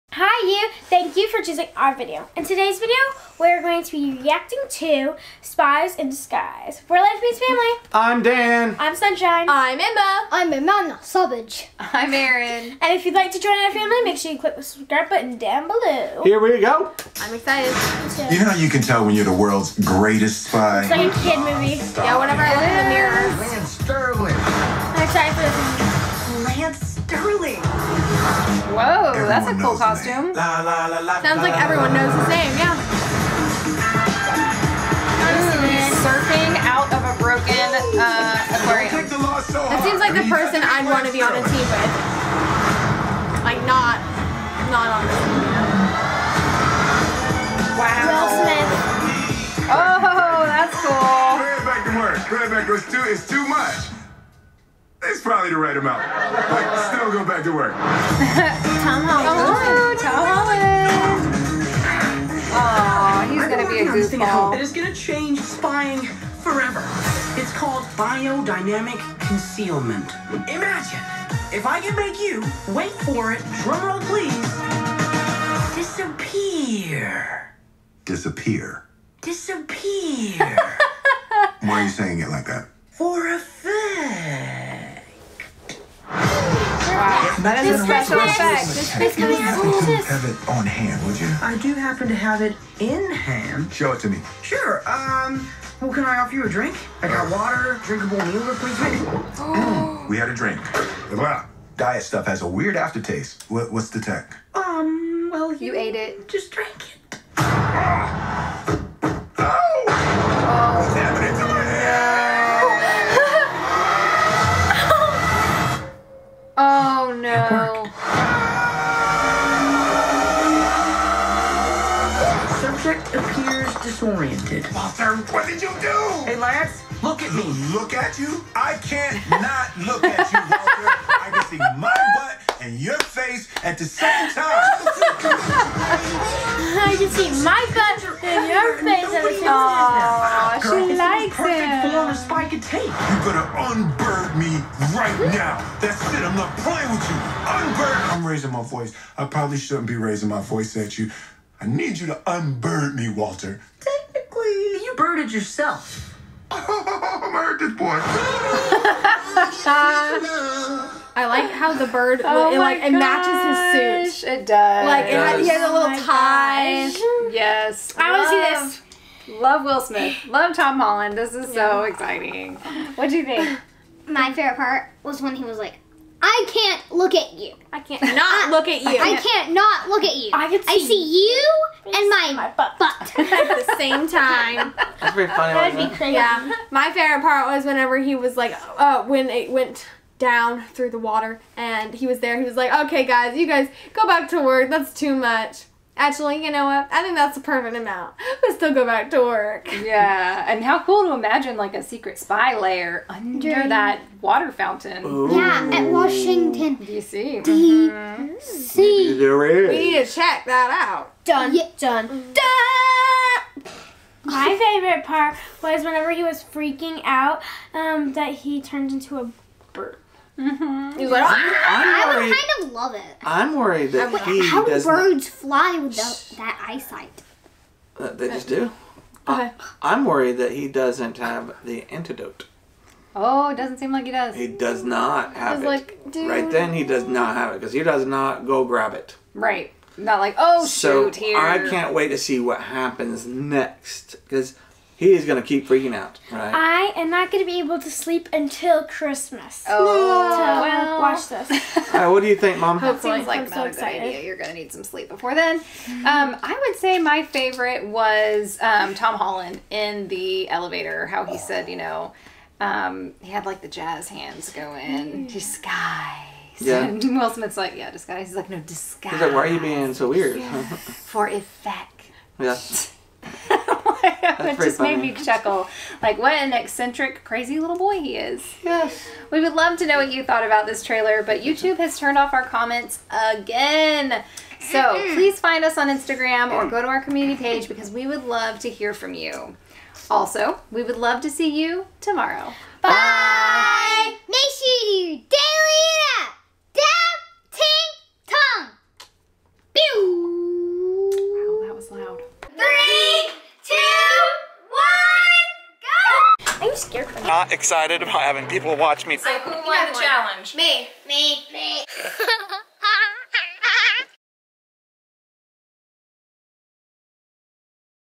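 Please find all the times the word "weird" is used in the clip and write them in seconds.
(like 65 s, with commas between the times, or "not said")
102 s, 270 s.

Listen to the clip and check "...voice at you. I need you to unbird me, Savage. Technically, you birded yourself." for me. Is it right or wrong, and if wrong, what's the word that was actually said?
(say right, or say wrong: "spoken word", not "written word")
wrong: "Walter", not "Savage".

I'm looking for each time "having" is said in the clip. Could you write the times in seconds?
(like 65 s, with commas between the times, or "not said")
308 s.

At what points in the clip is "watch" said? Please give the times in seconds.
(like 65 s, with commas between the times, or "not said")
251 s, 308 s.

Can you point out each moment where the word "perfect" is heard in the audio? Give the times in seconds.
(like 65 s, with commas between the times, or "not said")
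141 s, 197 s.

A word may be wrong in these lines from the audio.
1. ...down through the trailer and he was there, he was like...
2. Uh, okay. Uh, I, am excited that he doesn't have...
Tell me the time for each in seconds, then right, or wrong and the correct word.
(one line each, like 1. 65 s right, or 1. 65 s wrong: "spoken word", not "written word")
1. 190 s wrong: "water", not "trailer"
2. 229 s wrong: "worried", not "excited".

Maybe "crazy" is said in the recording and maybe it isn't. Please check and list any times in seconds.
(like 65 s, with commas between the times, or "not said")
185 s, 277 s.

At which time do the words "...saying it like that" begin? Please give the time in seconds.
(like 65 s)
81 s.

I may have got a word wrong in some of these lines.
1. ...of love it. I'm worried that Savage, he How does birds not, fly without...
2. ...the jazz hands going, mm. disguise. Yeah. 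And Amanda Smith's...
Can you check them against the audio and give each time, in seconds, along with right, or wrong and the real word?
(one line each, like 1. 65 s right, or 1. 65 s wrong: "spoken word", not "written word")
1. 222 s wrong: "Wait", not "Savage"
2. 263 s wrong: "Will", not "Amanda".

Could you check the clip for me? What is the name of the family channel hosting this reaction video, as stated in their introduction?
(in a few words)
Life Meets Family.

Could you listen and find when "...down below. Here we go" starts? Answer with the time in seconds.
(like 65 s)
15 s.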